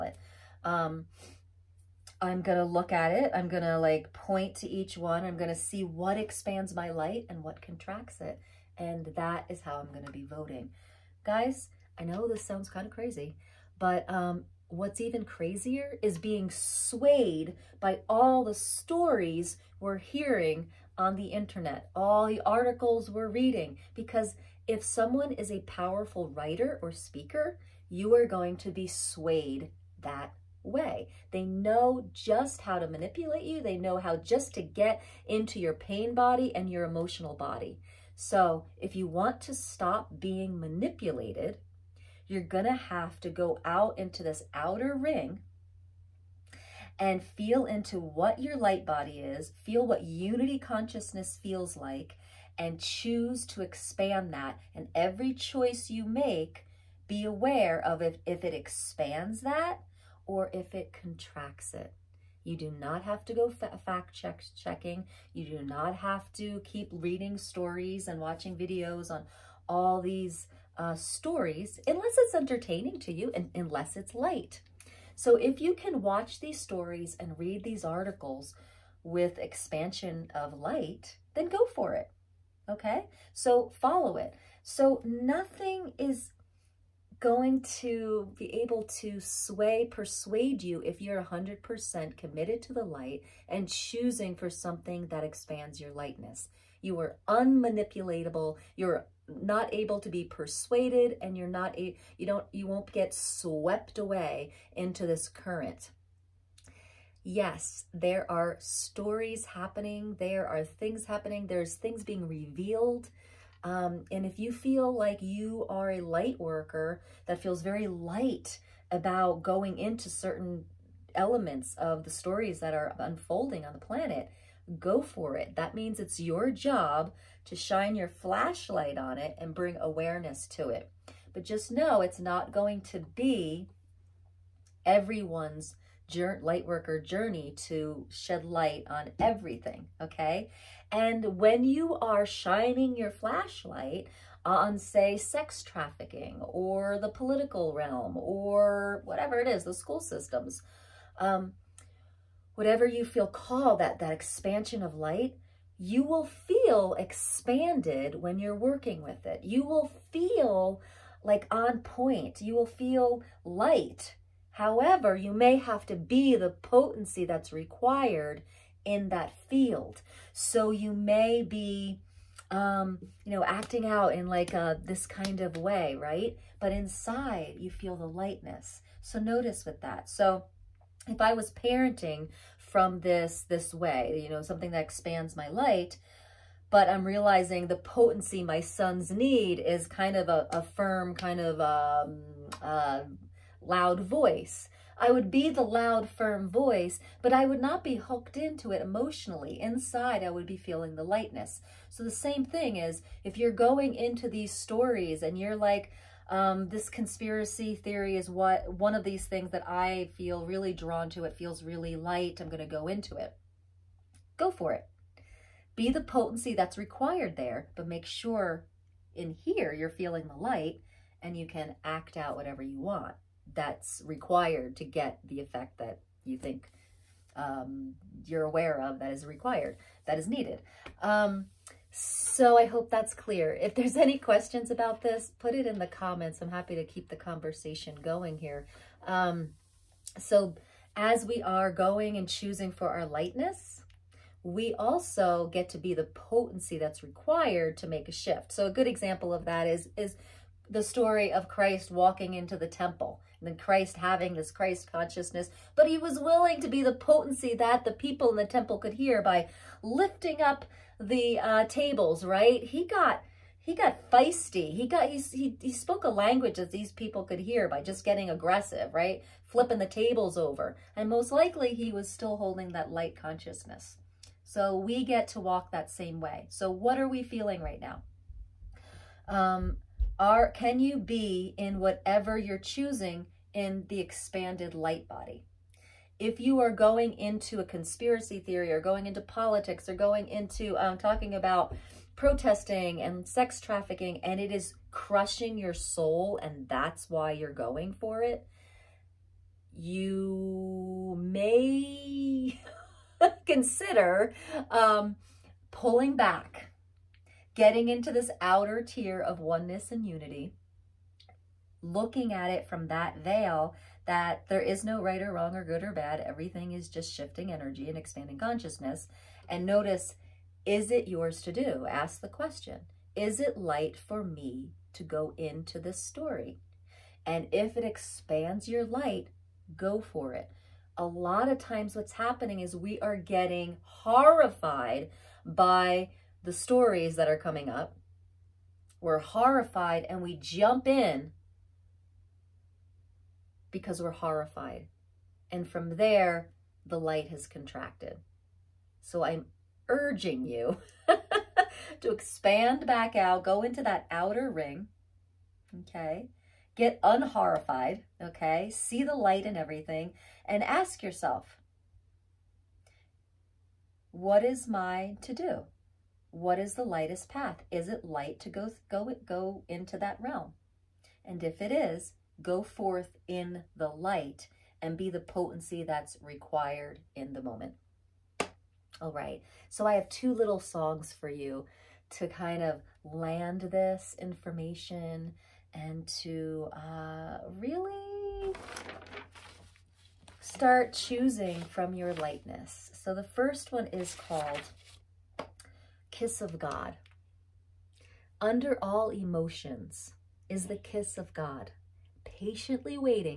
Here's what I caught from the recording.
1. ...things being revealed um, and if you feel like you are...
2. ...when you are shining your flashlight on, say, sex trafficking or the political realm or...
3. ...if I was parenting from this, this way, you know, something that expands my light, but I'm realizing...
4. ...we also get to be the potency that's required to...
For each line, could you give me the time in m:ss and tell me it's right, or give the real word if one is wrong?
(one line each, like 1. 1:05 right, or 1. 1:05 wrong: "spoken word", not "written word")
1. 1:51 right
2. 2:21 right
3. 3:01 right
4. 4:04 right.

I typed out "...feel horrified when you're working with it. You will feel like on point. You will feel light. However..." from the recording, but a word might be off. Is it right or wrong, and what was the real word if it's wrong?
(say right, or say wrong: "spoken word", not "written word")
wrong: "expanded", not "horrified".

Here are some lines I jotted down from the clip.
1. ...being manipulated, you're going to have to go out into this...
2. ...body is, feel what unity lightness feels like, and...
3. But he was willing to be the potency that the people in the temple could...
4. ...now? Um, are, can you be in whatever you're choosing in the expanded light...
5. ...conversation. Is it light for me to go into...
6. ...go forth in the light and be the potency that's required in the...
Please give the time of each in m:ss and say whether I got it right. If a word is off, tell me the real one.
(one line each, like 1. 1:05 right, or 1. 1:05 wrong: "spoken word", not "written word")
1. 0:40 right
2. 0:48 wrong: "consciousness", not "lightness"
3. 4:15 right
4. 4:37 right
5. 5:22 wrong: "question", not "conversation"
6. 6:12 right.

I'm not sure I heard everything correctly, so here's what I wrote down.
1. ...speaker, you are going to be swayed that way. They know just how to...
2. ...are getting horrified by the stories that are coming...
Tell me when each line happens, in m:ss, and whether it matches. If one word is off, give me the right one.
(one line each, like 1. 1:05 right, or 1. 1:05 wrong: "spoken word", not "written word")
1. 0:26 right
2. 5:33 right.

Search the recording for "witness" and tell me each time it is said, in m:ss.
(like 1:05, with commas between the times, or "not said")
not said.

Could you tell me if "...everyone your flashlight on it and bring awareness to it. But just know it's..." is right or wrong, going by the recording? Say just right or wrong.
wrong.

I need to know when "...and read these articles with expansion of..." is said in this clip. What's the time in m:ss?
1:17.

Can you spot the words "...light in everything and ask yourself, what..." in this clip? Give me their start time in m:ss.
5:59.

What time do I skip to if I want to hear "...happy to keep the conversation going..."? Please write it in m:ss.
3:56.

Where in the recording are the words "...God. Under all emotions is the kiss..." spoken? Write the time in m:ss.
6:36.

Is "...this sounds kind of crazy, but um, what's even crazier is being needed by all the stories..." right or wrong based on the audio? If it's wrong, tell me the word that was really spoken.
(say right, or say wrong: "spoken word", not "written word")
wrong: "swayed", not "needed".